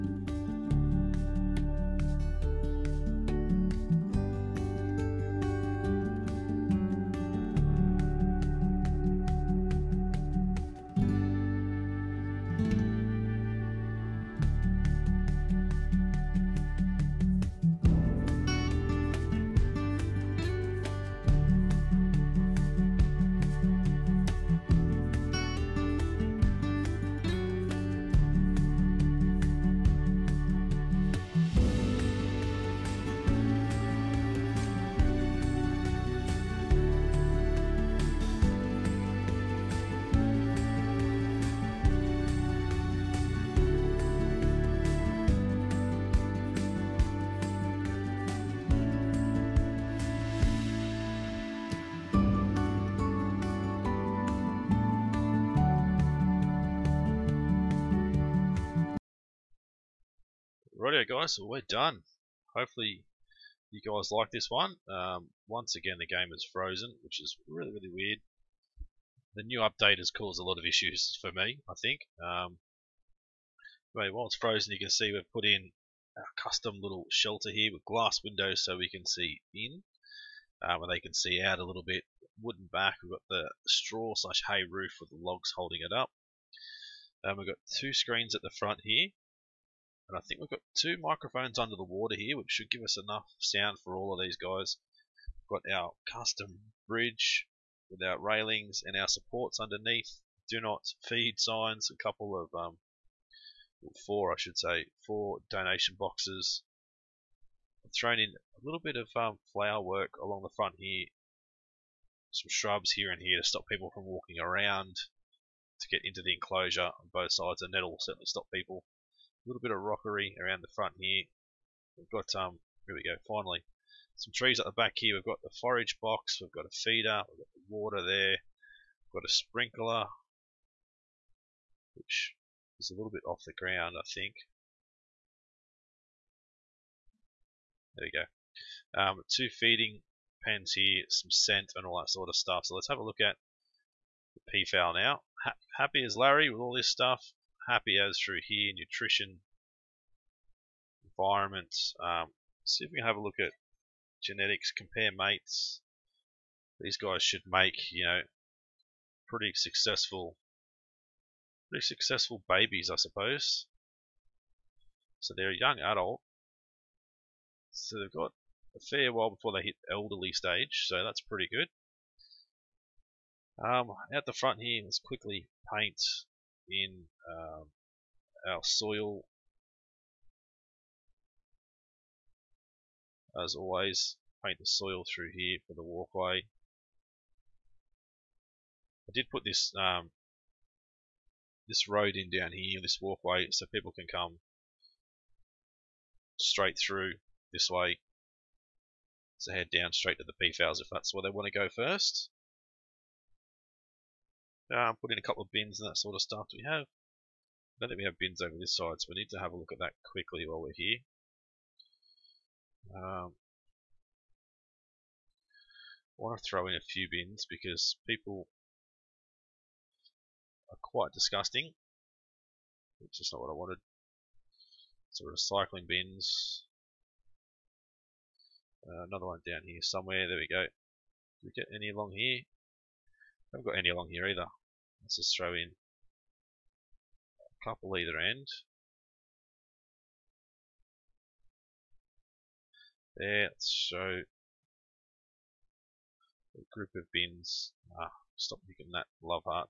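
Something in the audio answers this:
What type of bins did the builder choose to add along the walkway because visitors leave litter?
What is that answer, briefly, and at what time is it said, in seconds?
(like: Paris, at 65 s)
Recycling bins, at 225 s.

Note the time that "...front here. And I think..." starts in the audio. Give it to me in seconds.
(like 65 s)
88 s.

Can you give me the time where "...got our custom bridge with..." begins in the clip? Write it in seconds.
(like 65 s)
95 s.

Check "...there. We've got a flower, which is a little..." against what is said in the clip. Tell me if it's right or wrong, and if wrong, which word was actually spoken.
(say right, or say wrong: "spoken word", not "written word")
wrong: "sprinkler", not "flower".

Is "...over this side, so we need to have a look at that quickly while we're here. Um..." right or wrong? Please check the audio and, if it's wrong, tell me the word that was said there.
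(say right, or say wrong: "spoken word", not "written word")
right.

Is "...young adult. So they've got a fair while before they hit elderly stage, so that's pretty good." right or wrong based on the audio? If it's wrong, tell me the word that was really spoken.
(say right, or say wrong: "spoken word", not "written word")
right.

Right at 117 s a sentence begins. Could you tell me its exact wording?
The that will certainly stop people little bit of rockery around the front here.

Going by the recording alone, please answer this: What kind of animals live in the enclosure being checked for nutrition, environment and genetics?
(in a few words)
Peafowl.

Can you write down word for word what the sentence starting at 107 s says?
I've thrown in a little bit of um, flower work along the front here.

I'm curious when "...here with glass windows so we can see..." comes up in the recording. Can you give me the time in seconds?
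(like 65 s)
77 s.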